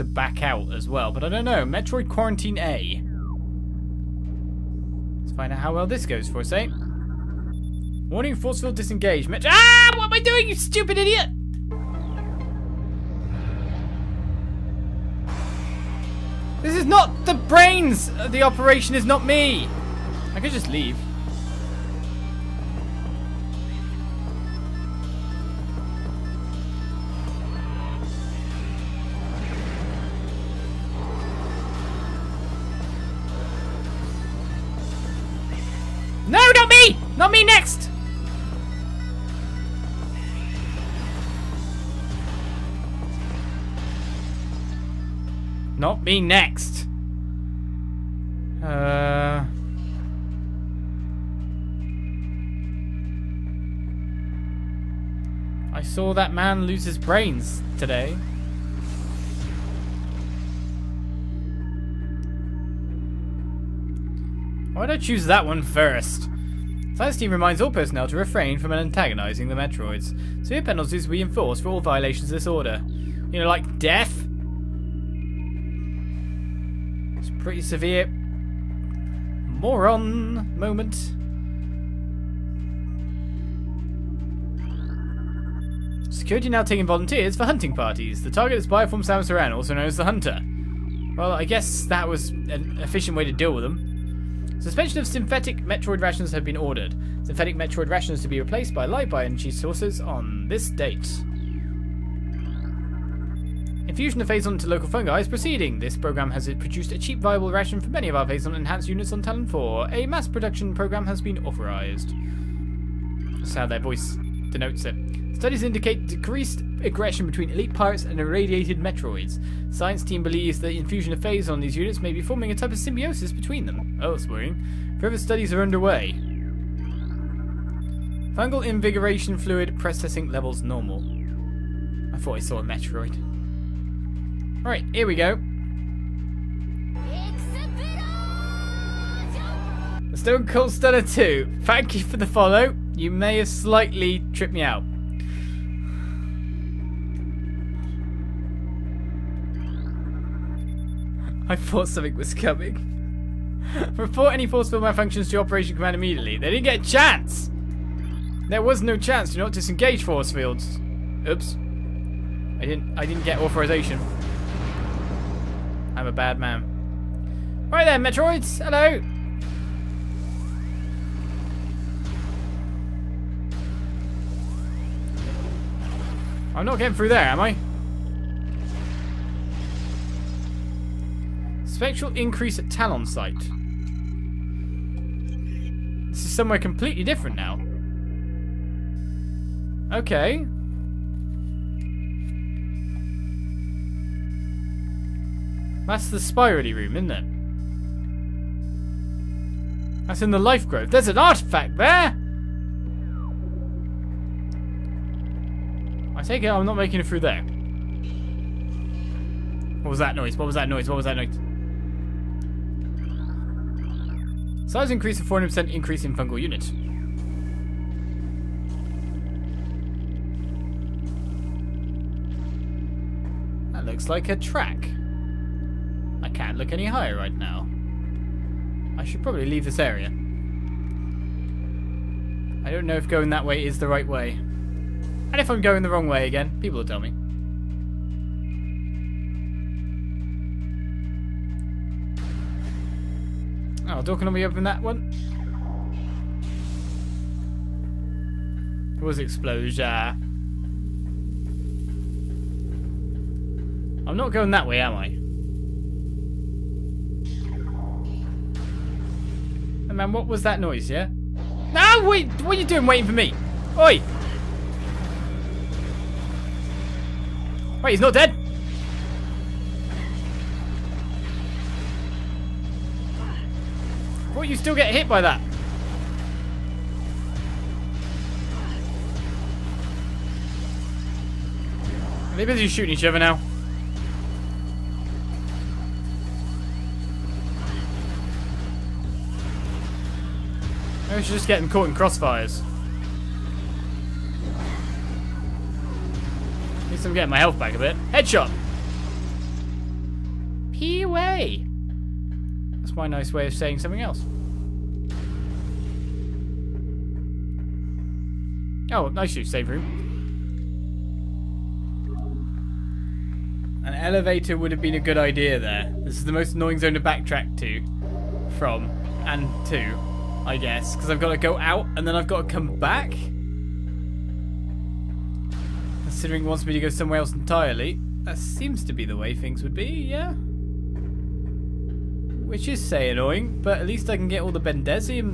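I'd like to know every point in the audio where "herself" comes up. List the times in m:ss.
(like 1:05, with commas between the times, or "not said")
not said.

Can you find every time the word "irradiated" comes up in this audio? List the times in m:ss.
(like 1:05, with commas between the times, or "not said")
1:58.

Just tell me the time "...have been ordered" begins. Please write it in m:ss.
1:36.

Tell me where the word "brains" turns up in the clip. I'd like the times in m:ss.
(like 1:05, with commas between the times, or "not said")
0:17, 0:56.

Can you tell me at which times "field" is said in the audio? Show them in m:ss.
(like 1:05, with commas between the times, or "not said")
0:08, 2:34, 2:40.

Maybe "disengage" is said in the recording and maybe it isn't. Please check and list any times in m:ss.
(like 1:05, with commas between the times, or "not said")
0:08, 2:39.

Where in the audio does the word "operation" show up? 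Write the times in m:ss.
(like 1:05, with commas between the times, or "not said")
0:18, 2:35.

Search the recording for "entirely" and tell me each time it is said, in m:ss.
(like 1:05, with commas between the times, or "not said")
5:27.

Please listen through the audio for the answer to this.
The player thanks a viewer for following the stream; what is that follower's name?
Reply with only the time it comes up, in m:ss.
2:20.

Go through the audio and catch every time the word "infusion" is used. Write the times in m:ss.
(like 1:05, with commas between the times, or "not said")
1:43, 2:00.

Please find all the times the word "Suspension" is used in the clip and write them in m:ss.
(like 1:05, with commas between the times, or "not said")
1:34.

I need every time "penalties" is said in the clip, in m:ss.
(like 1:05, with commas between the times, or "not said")
1:10.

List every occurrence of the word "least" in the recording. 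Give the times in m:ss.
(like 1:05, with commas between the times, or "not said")
4:56, 5:33.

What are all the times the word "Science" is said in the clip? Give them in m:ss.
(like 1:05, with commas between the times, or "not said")
1:06, 1:59.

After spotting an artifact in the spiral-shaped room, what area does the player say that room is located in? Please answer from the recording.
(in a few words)
The life grove.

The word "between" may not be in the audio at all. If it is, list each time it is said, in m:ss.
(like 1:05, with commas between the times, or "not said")
1:57, 2:03.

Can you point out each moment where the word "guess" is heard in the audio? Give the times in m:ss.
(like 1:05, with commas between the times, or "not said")
1:31, 5:20.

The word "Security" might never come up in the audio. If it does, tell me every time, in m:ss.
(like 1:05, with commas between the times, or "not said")
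1:26.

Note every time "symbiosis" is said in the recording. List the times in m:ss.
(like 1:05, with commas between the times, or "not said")
2:02.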